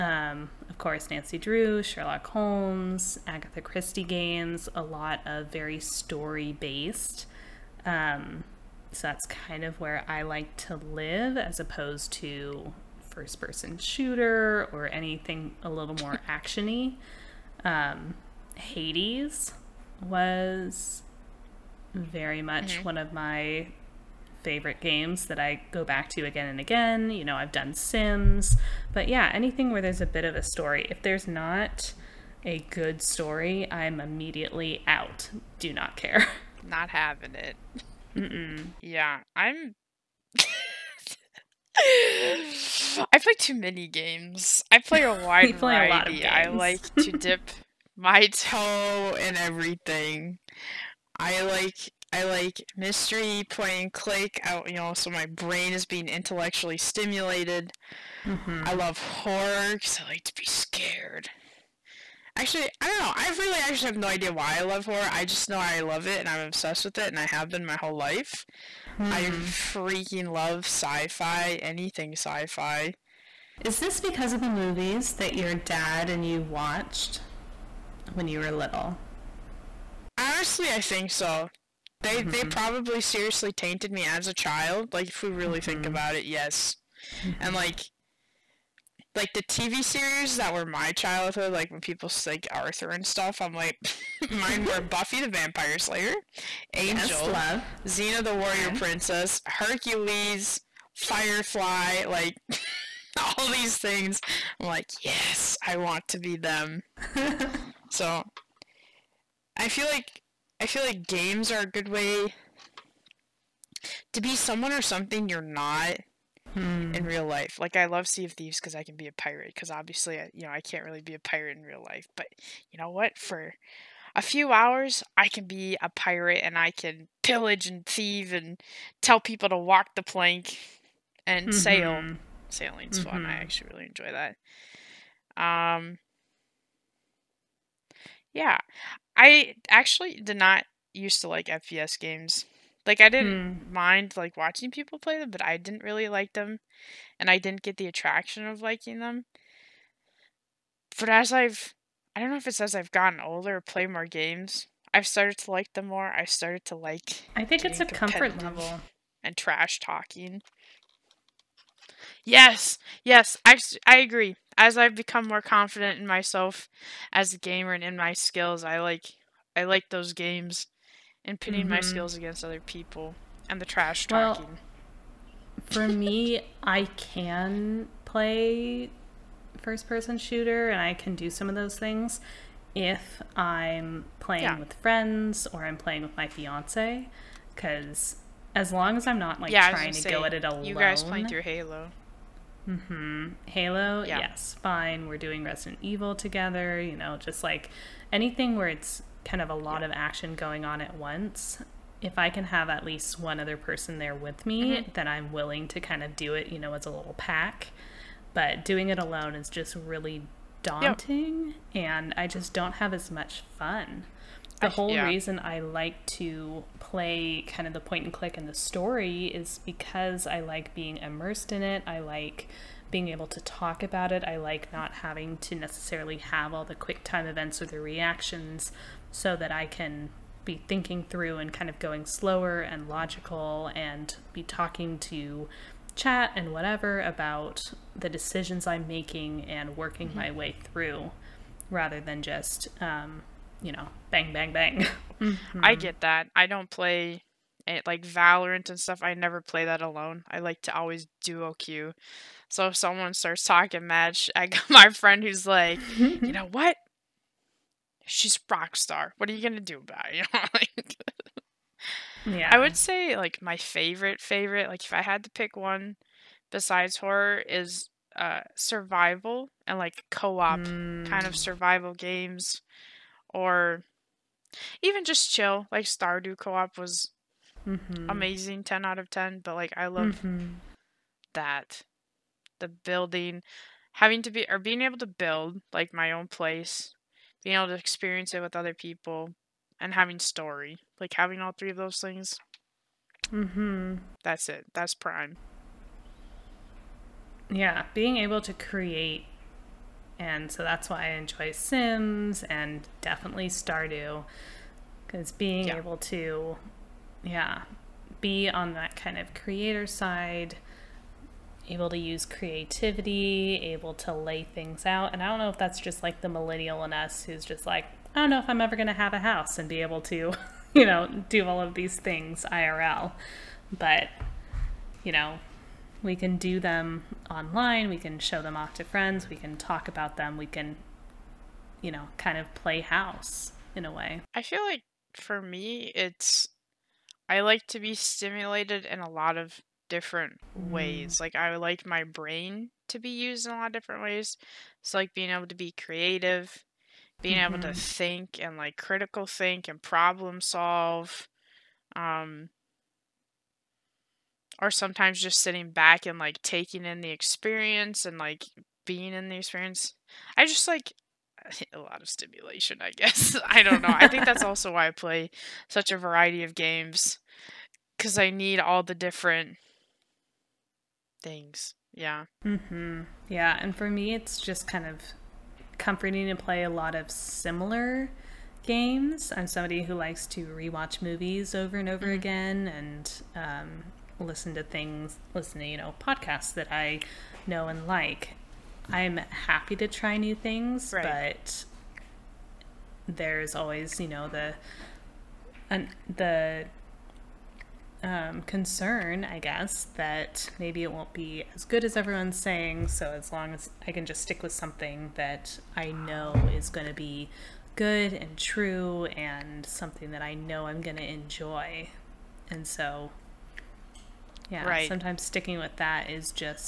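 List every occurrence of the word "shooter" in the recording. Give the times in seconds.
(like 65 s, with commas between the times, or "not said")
13 s, 180 s.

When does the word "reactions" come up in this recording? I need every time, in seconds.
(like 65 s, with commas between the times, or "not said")
227 s.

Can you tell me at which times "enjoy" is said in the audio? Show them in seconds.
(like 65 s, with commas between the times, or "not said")
133 s, 301 s, 411 s.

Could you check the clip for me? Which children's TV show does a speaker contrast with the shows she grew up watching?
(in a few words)
Arthur.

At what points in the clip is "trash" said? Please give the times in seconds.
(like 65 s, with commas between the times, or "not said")
159 s, 173 s.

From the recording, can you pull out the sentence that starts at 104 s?
I'm like, yes, I want to be them.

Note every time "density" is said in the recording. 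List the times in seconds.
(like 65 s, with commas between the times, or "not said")
not said.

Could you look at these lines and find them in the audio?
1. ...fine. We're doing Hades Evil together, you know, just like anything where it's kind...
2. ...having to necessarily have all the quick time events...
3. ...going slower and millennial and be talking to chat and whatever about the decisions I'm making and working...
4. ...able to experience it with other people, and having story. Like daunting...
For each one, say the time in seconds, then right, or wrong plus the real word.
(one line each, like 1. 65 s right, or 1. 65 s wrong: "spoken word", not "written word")
1. 194 s wrong: "Resident", not "Hades"
2. 224 s right
3. 231 s wrong: "logical", not "millennial"
4. 287 s wrong: "having", not "daunting".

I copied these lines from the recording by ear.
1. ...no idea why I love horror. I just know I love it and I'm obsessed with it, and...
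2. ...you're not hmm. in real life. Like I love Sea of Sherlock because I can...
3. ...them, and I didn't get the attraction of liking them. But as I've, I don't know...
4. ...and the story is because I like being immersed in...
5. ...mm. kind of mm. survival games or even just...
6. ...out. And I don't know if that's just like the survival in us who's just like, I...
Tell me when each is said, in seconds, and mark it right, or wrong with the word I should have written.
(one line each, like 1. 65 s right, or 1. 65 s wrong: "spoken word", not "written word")
1. 63 s right
2. 115 s wrong: "Thieves", not "Sherlock"
3. 146 s right
4. 218 s right
5. 270 s right
6. 314 s wrong: "millennial", not "survival".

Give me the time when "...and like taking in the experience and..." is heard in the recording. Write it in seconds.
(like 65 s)
356 s.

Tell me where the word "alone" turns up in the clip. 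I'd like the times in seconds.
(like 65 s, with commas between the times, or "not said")
190 s, 208 s, 249 s.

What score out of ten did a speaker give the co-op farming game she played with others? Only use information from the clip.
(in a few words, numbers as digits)
10 out of 10.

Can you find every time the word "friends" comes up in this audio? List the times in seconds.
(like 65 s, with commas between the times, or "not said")
184 s, 254 s, 328 s.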